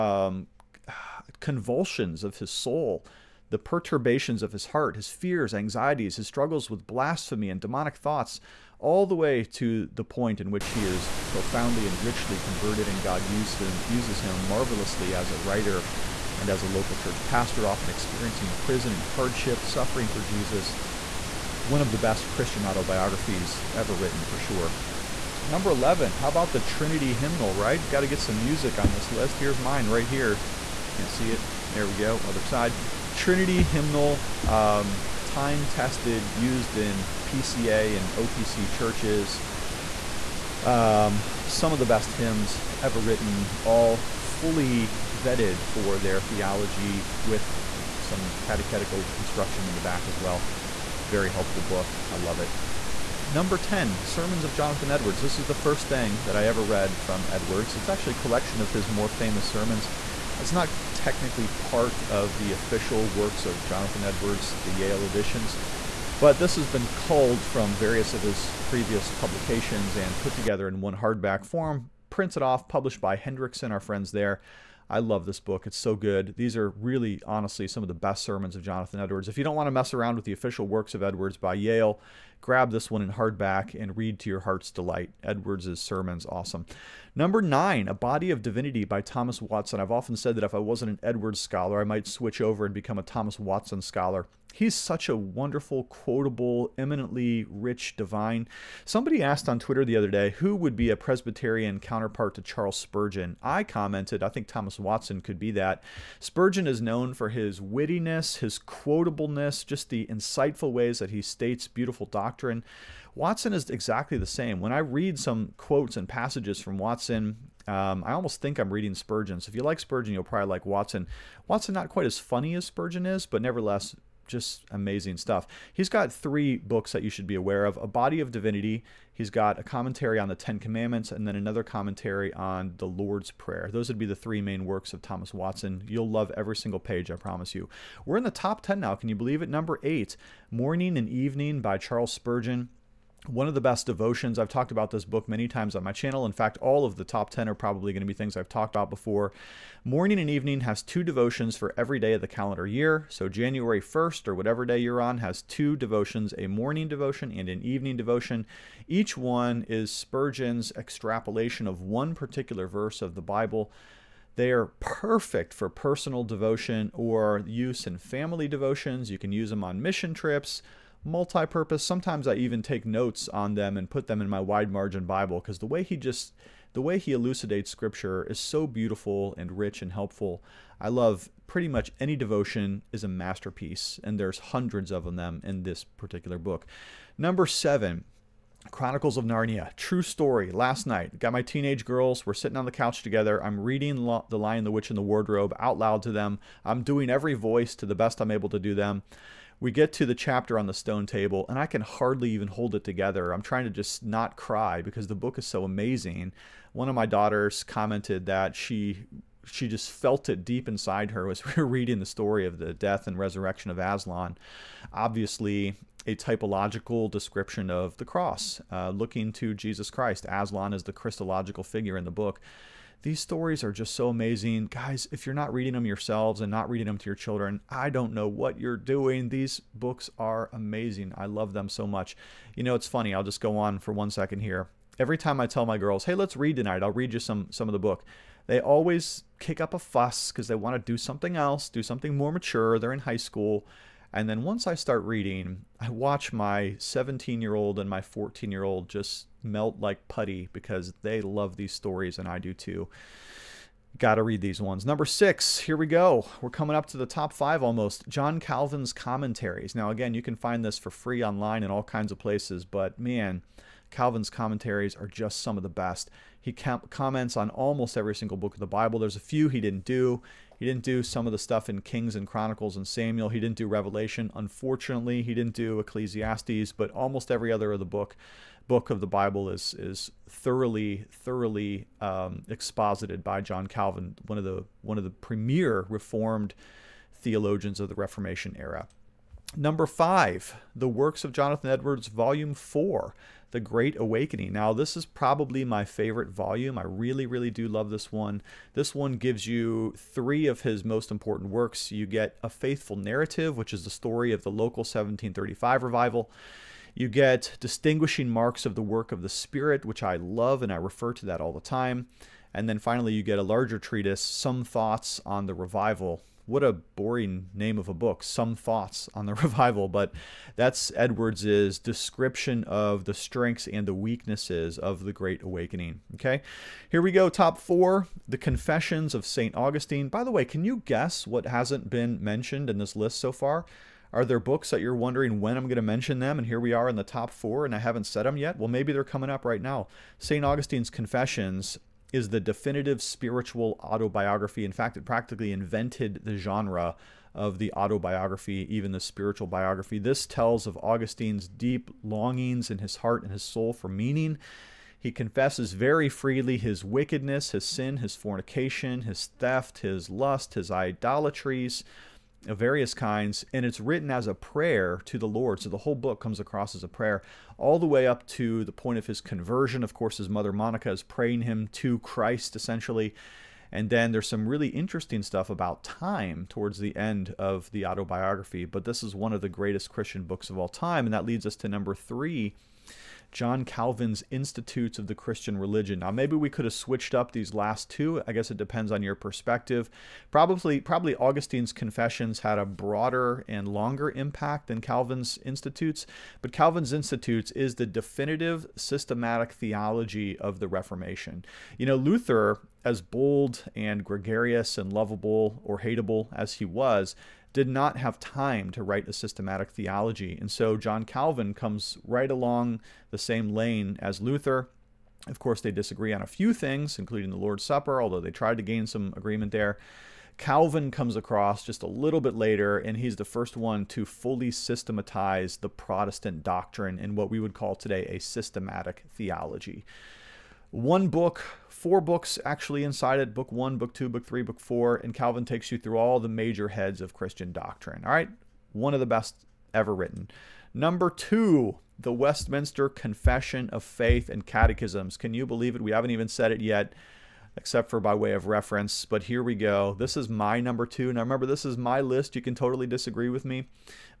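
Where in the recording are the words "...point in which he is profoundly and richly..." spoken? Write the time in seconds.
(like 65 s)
10 s.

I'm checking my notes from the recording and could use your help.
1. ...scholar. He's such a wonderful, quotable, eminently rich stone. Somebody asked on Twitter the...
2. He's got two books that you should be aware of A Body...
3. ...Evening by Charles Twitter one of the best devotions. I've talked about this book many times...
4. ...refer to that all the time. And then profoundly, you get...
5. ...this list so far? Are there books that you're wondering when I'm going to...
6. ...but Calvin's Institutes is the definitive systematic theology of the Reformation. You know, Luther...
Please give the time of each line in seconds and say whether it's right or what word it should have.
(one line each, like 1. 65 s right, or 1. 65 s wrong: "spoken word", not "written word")
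1. 93 s wrong: "divine", not "stone"
2. 125 s wrong: "three", not "two"
3. 141 s wrong: "Spurgeon", not "Twitter"
4. 310 s wrong: "finally", not "profoundly"
5. 332 s right
6. 396 s right.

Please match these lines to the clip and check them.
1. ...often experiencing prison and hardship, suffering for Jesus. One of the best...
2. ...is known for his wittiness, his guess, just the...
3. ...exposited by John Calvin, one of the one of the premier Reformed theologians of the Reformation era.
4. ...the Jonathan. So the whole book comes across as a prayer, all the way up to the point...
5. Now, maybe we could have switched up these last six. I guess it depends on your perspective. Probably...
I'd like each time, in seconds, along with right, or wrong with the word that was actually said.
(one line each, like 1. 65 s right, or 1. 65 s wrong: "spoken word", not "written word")
1. 17 s right
2. 106 s wrong: "quotableness", not "guess"
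3. 282 s right
4. 365 s wrong: "Lord", not "Jonathan"
5. 386 s wrong: "two", not "six".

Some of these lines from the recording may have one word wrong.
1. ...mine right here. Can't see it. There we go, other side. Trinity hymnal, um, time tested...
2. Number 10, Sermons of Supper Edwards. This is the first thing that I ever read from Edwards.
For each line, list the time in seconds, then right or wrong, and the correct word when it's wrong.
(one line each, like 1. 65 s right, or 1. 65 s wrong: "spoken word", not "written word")
1. 29 s right
2. 53 s wrong: "Jonathan", not "Supper".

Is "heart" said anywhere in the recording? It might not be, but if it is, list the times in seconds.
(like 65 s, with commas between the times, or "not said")
4 s, 84 s, 352 s.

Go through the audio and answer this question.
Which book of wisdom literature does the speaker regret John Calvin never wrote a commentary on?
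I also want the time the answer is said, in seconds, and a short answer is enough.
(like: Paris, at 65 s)
Ecclesiastes, at 275 s.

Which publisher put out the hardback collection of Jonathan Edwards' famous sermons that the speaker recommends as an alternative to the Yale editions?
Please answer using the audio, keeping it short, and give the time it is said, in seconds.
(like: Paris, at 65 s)
Hendrickson, at 73 s.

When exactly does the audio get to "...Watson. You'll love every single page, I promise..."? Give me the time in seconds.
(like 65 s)
135 s.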